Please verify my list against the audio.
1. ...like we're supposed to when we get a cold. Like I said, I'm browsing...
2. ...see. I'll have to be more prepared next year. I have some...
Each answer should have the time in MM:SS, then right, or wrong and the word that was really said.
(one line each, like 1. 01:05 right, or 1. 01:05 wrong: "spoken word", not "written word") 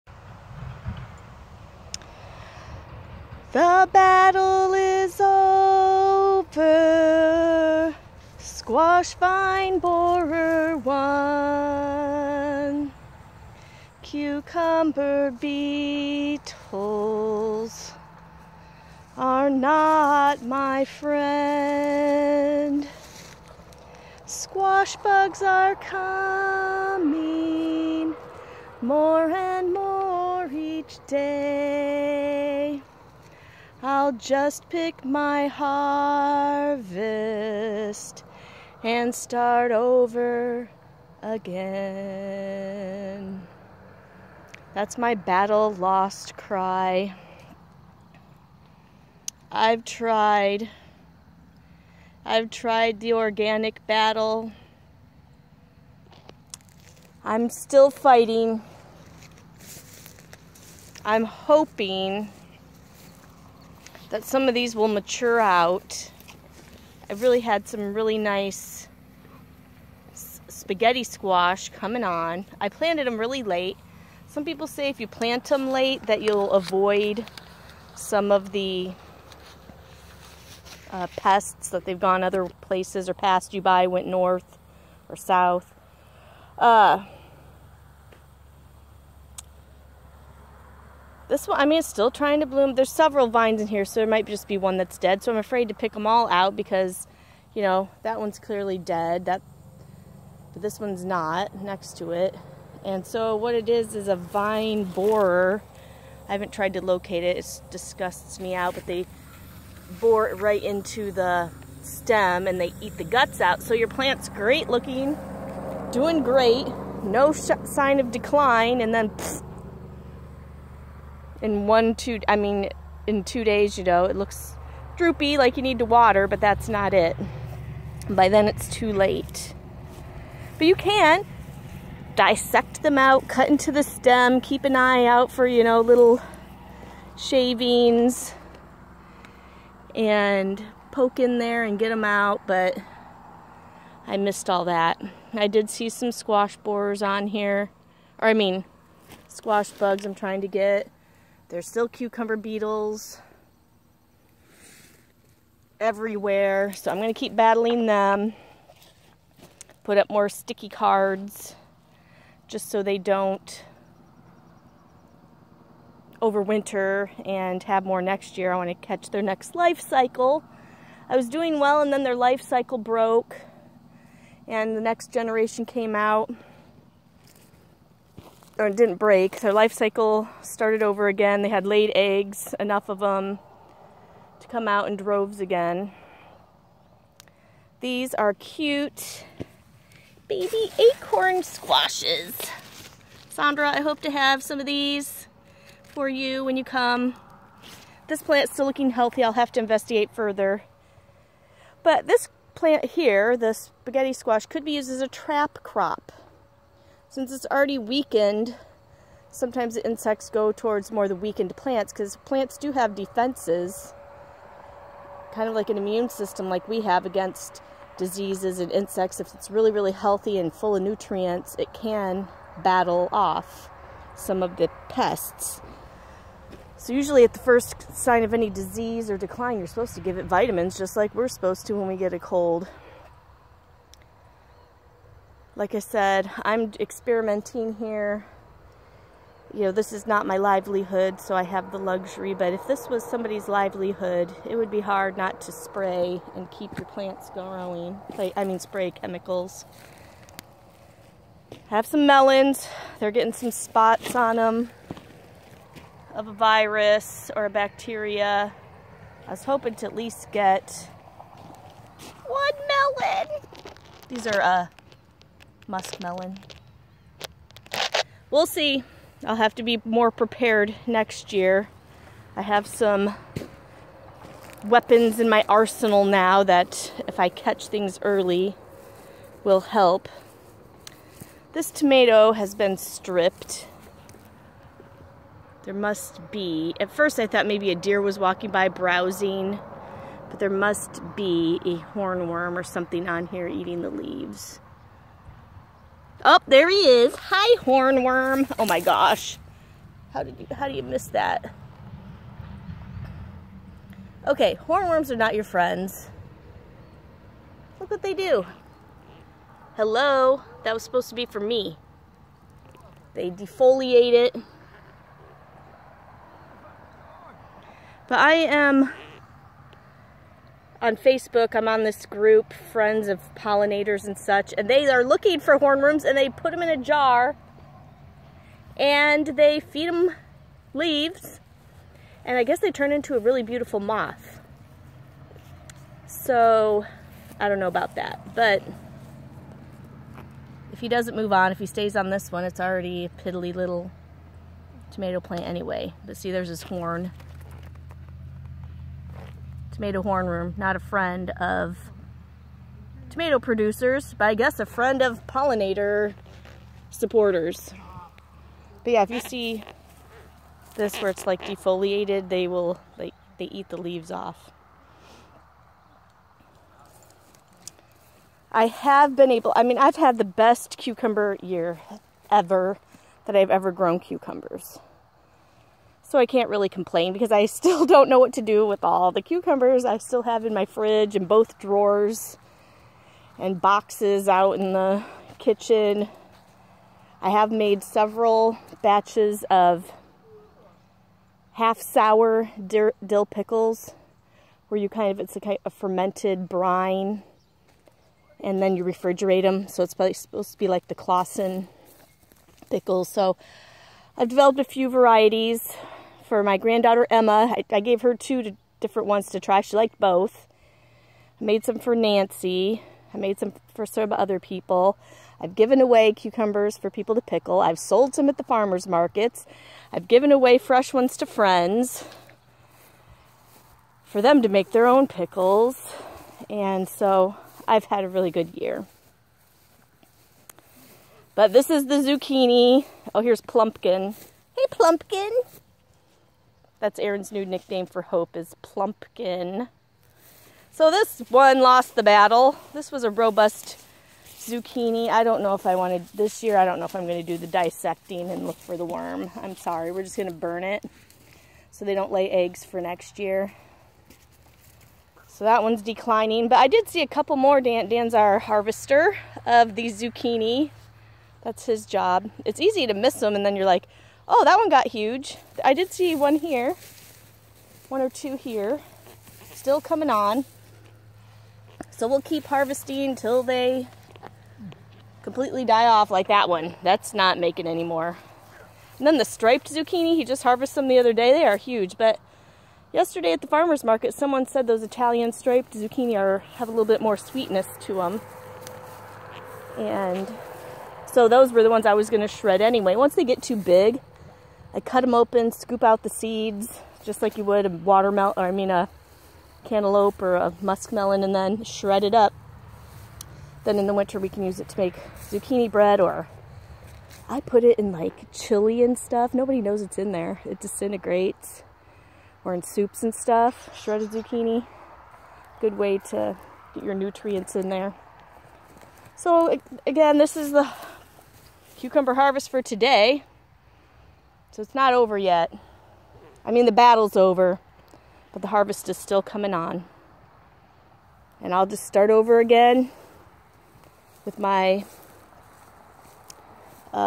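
1. 03:50 wrong: "experimenting", not "browsing"
2. 04:28 right.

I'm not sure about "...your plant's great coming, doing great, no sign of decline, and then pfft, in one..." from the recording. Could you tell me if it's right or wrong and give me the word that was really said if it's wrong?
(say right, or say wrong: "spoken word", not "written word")
wrong: "looking", not "coming".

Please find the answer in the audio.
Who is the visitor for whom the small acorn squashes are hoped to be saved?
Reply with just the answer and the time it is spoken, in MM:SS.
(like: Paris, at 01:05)
Sandra, at 03:13.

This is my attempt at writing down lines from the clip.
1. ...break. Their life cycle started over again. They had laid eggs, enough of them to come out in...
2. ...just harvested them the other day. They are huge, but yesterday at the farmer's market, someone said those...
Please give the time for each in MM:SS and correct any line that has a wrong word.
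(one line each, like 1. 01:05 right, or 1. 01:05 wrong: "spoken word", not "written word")
1. 02:58 right
2. 08:00 right.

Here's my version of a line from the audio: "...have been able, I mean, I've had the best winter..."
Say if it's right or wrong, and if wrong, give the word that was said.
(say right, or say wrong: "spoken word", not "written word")
wrong: "cucumber", not "winter".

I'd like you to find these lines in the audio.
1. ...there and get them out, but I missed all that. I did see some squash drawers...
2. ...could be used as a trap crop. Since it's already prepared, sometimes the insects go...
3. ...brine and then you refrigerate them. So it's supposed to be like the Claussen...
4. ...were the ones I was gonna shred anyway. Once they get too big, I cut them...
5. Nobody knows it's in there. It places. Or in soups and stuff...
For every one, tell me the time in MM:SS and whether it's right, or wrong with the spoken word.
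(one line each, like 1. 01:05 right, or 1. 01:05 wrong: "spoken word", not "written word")
1. 02:21 wrong: "borers", not "drawers"
2. 03:24 wrong: "weakened", not "prepared"
3. 06:36 right
4. 08:11 right
5. 08:29 wrong: "disintegrates", not "places".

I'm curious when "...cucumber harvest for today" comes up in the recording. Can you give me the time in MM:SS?
08:41.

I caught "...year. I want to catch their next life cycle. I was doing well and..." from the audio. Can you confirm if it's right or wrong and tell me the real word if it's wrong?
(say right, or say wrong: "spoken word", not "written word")
right.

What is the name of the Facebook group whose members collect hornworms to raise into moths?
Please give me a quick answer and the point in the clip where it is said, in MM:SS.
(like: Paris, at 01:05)
Friends of Pollinators, at 05:22.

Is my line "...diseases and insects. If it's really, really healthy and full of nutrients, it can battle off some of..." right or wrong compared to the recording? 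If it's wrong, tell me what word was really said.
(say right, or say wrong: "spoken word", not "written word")
right.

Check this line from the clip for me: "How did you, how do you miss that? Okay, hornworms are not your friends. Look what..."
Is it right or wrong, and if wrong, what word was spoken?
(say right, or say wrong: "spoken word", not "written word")
right.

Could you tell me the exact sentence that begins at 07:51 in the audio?
So we'll keep harvesting till they completely die off like that one.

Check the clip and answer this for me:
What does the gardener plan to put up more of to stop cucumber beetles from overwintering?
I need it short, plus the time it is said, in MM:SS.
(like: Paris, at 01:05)
sticky cards, at 02:40.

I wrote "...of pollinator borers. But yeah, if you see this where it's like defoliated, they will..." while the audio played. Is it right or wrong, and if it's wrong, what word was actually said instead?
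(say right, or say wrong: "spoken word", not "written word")
wrong: "supporters", not "borers".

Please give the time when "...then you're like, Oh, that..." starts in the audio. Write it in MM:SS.
07:43.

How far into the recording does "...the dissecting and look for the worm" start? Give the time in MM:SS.
07:27.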